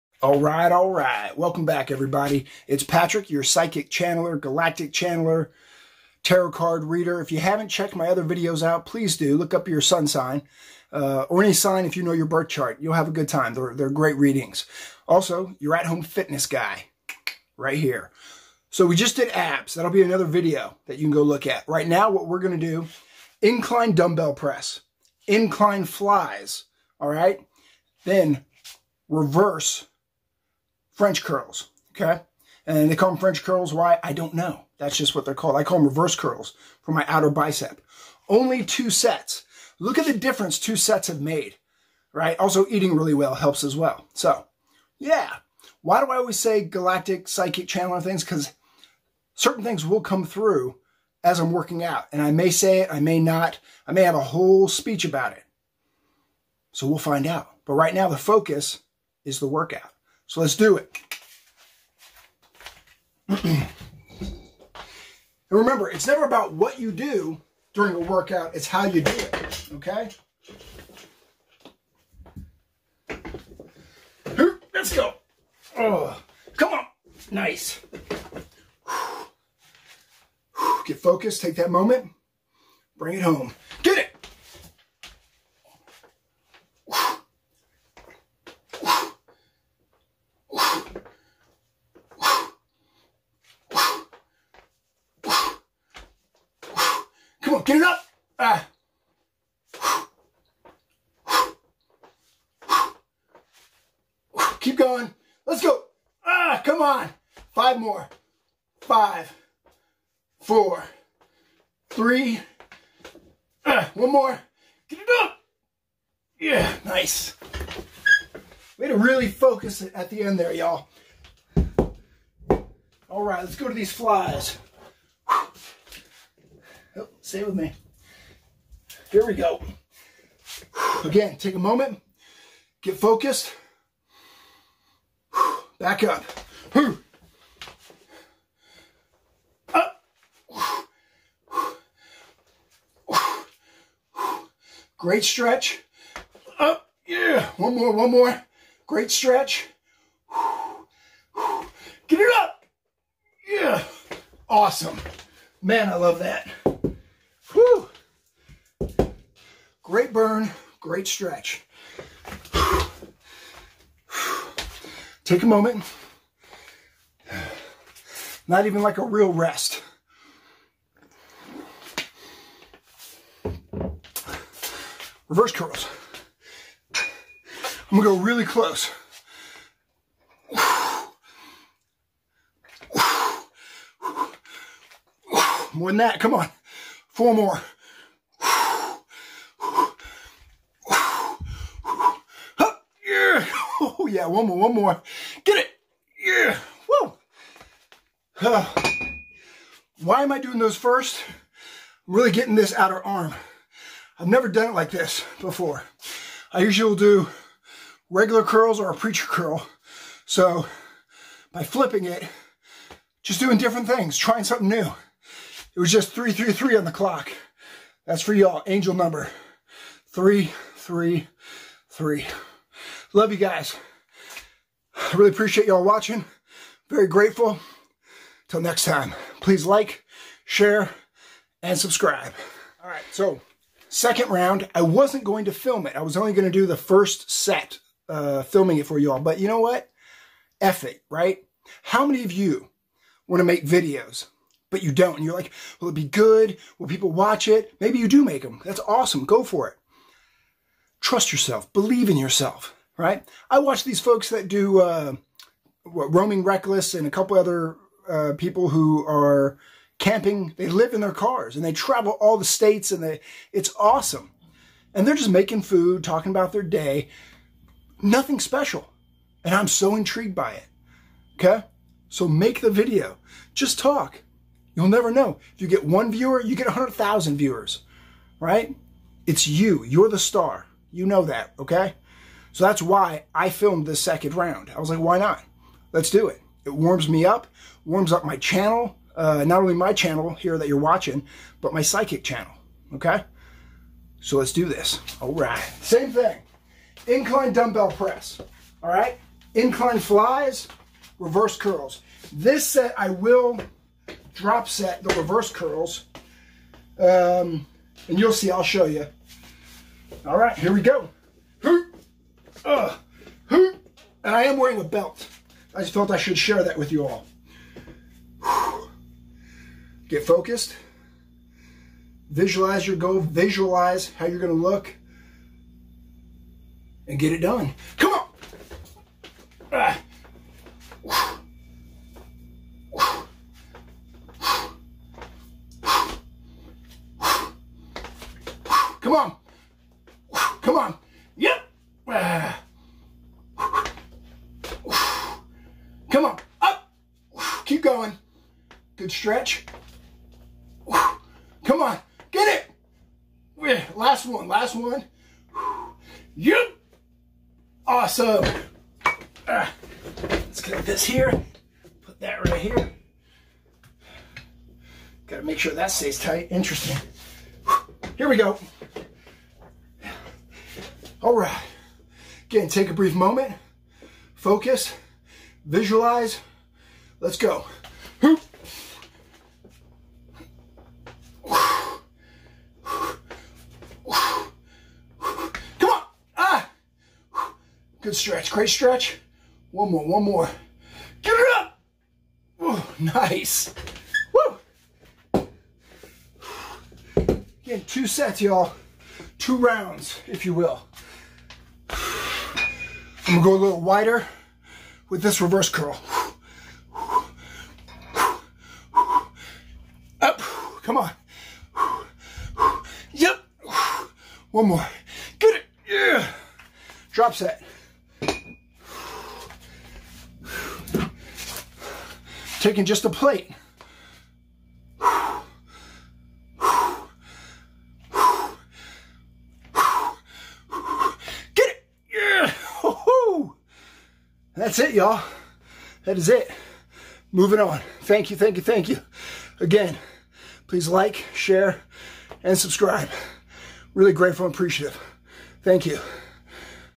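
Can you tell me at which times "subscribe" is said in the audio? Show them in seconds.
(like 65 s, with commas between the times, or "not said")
231 s, 442 s.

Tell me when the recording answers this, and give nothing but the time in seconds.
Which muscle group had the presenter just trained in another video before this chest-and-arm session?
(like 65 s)
19 s.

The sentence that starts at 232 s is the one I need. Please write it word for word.
All right, so second round, I wasn't going to film it.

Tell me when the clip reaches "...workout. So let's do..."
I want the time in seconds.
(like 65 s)
59 s.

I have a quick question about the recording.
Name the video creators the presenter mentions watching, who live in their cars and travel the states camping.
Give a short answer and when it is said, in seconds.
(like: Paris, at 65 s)
Roaming Reckless, at 255 s.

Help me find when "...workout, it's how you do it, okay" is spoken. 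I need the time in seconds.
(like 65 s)
67 s.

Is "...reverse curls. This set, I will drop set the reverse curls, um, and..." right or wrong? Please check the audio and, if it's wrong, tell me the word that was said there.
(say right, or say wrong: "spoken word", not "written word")
right.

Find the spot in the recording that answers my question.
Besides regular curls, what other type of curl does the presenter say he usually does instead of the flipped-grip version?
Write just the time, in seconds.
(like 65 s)
208 s.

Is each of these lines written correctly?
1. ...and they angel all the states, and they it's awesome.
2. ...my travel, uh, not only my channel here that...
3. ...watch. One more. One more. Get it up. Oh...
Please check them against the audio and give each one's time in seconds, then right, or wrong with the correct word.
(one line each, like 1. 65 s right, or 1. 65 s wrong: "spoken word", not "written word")
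1. 261 s wrong: "travel", not "angel"
2. 288 s wrong: "channel", not "travel"
3. 388 s wrong: "stretch", not "watch".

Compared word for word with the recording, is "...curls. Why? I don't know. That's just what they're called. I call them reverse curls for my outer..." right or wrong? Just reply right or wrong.
right.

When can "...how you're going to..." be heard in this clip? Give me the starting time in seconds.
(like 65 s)
324 s.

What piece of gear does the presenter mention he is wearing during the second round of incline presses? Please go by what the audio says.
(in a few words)
a belt.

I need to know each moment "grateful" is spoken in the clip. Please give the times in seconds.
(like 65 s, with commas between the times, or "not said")
227 s, 444 s.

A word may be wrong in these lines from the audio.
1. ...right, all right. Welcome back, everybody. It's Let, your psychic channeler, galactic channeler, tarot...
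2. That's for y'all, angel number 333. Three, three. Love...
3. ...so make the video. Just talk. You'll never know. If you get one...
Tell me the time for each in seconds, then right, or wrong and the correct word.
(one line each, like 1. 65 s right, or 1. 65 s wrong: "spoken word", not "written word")
1. 0 s wrong: "Patrick", not "Let"
2. 218 s right
3. 272 s right.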